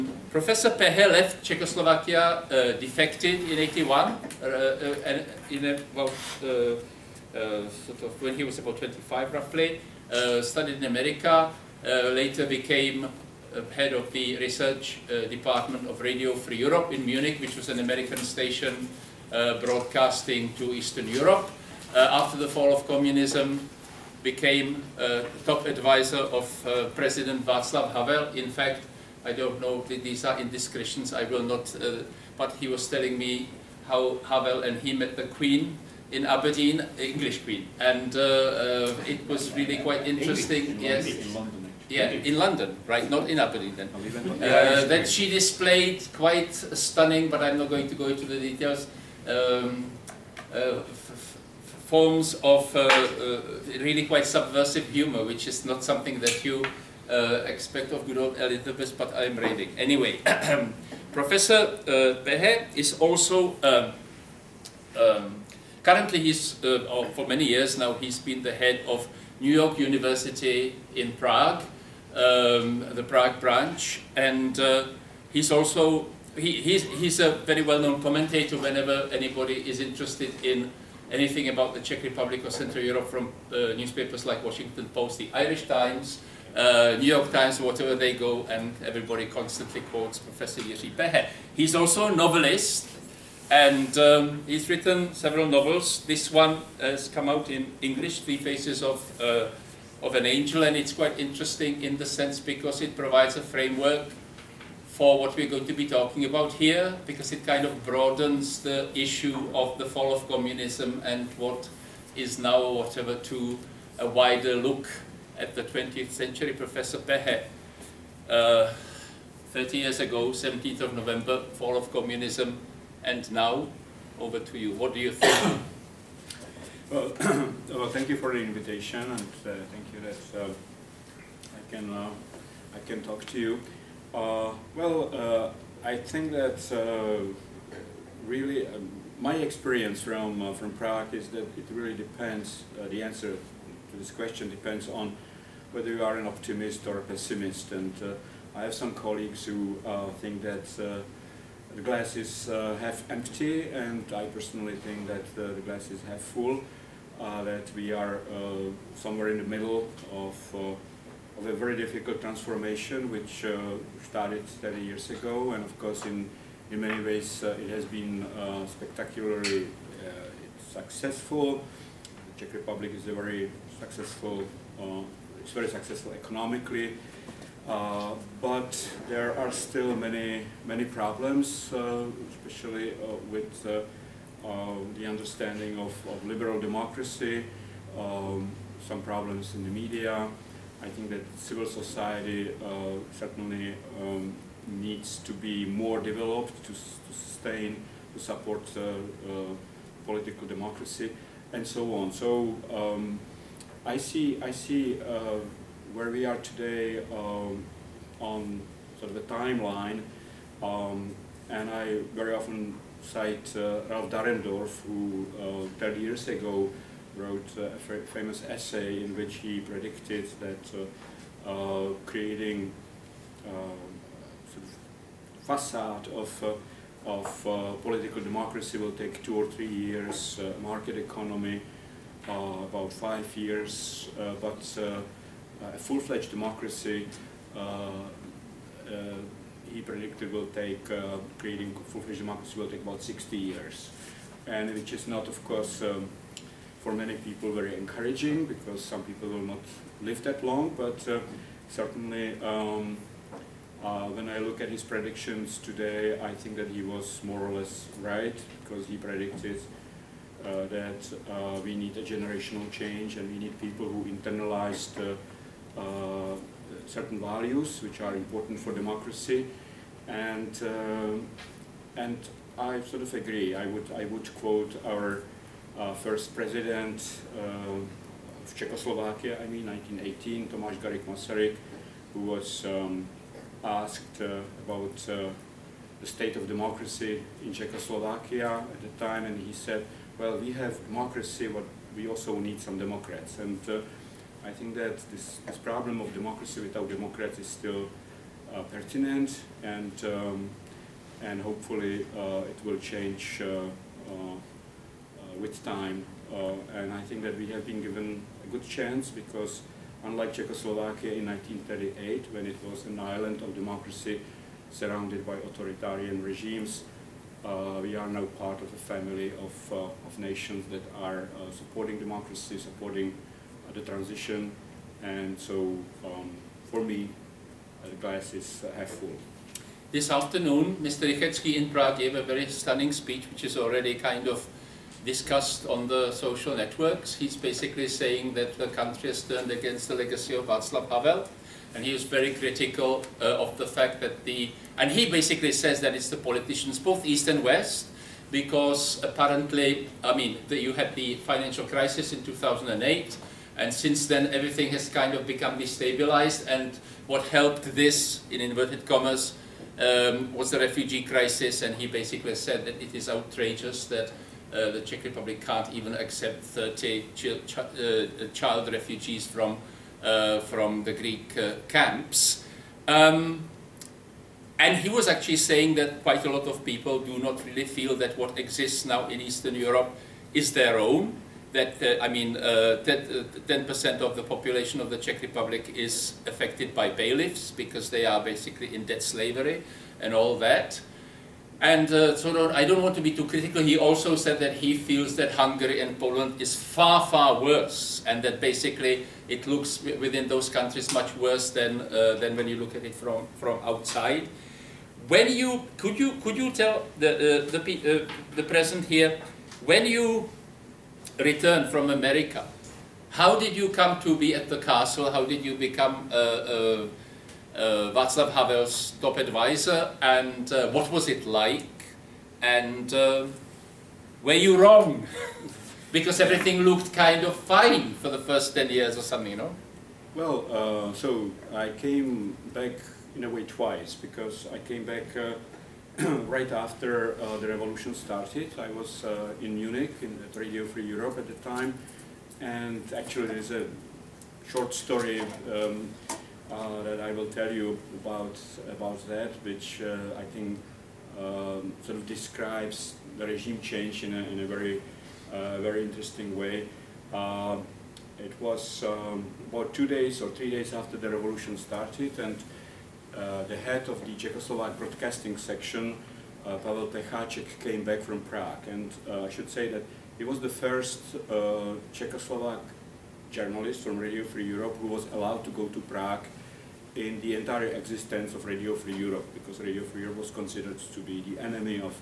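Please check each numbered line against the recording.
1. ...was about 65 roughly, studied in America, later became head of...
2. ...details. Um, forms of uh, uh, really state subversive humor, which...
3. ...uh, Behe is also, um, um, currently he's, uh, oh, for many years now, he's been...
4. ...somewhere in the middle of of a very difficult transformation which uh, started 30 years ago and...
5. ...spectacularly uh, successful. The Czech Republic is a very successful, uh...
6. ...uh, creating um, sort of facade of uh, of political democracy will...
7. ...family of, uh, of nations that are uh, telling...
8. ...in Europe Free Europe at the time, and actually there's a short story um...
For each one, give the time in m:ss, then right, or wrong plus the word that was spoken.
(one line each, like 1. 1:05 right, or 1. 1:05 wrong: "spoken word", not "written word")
1. 0:08 wrong: "25", not "65"
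2. 0:48 wrong: "quite", not "state"
3. 1:01 right
4. 2:38 right
5. 2:48 right
6. 3:41 right
7. 5:18 wrong: "supporting", not "telling"
8. 7:20 wrong: "Radio", not "Europe".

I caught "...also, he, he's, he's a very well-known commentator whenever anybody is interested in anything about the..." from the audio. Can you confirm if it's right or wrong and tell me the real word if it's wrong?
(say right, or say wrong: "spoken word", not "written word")
right.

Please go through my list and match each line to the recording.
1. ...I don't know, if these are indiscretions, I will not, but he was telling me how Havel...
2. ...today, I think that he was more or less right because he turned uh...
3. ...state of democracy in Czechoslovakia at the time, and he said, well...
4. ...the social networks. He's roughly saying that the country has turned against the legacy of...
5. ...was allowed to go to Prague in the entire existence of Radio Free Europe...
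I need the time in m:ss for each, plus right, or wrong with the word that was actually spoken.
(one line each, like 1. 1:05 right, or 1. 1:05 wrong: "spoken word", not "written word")
1. 0:29 right
2. 4:15 wrong: "predicted", not "turned"
3. 4:46 right
4. 5:35 wrong: "basically", not "roughly"
5. 7:54 right.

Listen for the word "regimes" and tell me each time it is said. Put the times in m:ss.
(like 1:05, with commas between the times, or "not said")
5:16, 7:33.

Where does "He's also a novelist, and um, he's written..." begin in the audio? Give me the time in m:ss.
1:31.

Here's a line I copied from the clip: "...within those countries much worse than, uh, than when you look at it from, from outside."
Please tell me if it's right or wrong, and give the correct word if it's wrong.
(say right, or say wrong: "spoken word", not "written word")
right.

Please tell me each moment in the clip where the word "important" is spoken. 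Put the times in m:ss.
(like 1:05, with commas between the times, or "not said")
4:28.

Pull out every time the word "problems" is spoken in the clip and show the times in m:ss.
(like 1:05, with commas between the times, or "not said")
3:00, 3:09, 4:55.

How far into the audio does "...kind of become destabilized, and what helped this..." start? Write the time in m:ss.
5:54.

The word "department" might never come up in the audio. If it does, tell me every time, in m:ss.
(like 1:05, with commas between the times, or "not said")
0:15.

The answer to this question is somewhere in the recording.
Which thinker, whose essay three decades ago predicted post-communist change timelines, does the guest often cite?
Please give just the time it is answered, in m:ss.
3:33.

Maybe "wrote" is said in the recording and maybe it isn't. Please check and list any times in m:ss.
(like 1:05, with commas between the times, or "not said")
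3:37.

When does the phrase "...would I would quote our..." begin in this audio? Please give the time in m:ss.
4:33.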